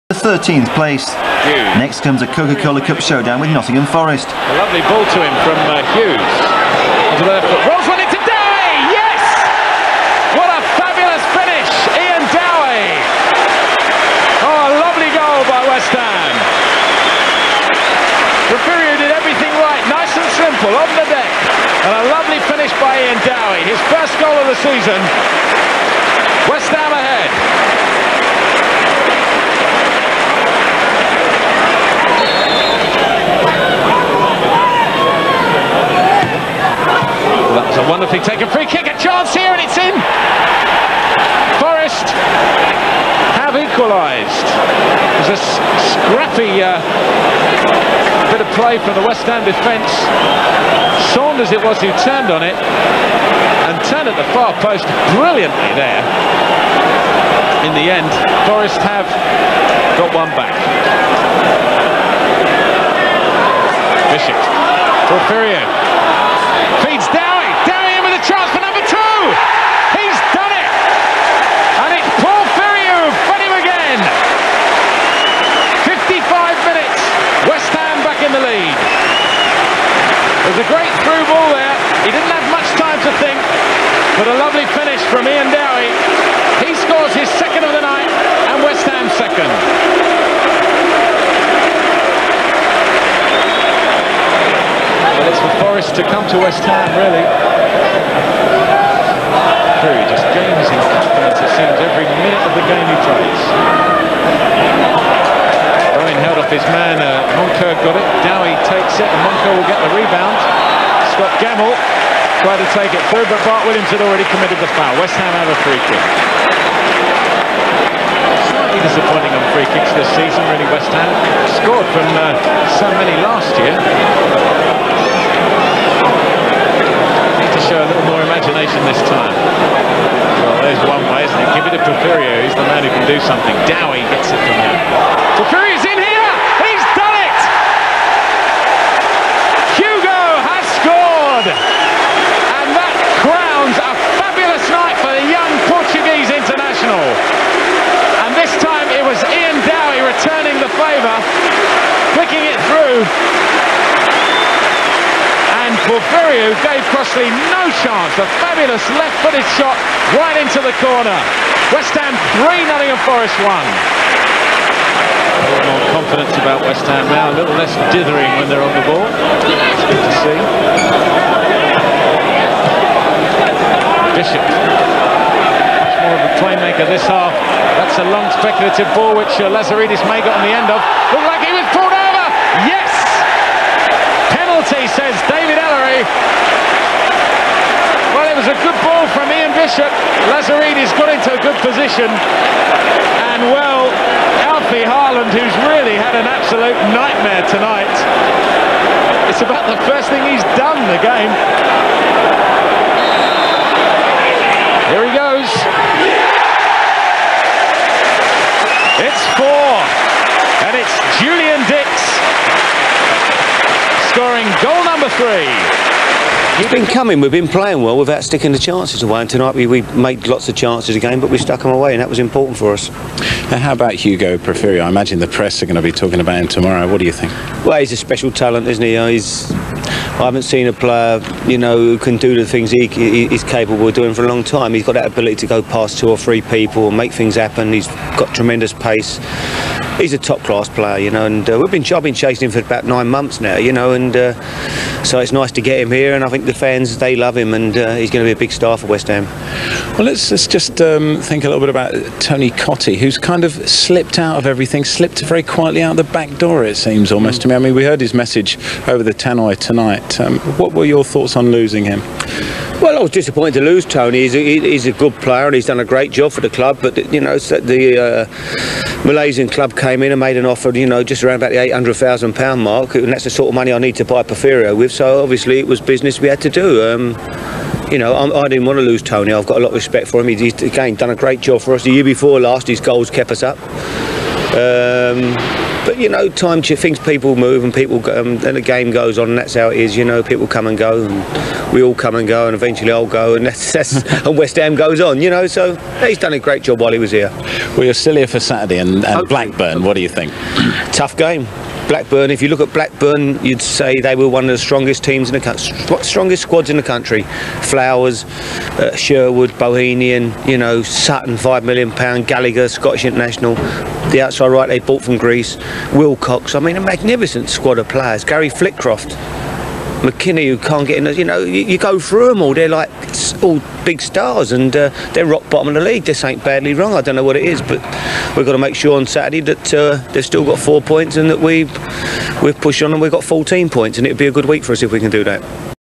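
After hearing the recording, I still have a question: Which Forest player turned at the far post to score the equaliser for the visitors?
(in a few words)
Saunders.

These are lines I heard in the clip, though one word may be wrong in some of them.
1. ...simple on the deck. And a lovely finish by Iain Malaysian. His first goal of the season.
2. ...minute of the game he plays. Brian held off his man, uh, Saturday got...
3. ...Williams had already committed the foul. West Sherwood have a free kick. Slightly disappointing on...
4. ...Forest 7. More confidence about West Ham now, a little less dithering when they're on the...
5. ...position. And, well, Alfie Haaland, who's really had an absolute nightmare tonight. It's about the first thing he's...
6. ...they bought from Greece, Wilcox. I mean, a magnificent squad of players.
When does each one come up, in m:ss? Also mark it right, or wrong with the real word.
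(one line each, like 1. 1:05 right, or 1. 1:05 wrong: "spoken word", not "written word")
1. 0:20 wrong: "Dowie", not "Malaysian"
2. 1:42 wrong: "Monker", not "Saturday"
3. 1:53 wrong: "Ham", not "Sherwood"
4. 2:43 wrong: "1", not "7"
5. 3:11 right
6. 5:14 right.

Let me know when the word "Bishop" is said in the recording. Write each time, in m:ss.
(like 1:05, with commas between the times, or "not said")
1:04, 2:54, 3:09.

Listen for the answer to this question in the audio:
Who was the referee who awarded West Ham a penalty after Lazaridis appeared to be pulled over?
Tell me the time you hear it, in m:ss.
3:05.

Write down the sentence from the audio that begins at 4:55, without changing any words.
You know, so he's done a great job while he was here.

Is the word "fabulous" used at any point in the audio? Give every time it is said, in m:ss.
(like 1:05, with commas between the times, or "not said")
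0:10, 2:38.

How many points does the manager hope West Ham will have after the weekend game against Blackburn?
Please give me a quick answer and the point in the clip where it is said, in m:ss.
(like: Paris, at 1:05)
14, at 5:33.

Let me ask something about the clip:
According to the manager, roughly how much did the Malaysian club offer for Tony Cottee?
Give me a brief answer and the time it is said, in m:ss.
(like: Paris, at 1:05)
£800,000, at 4:31.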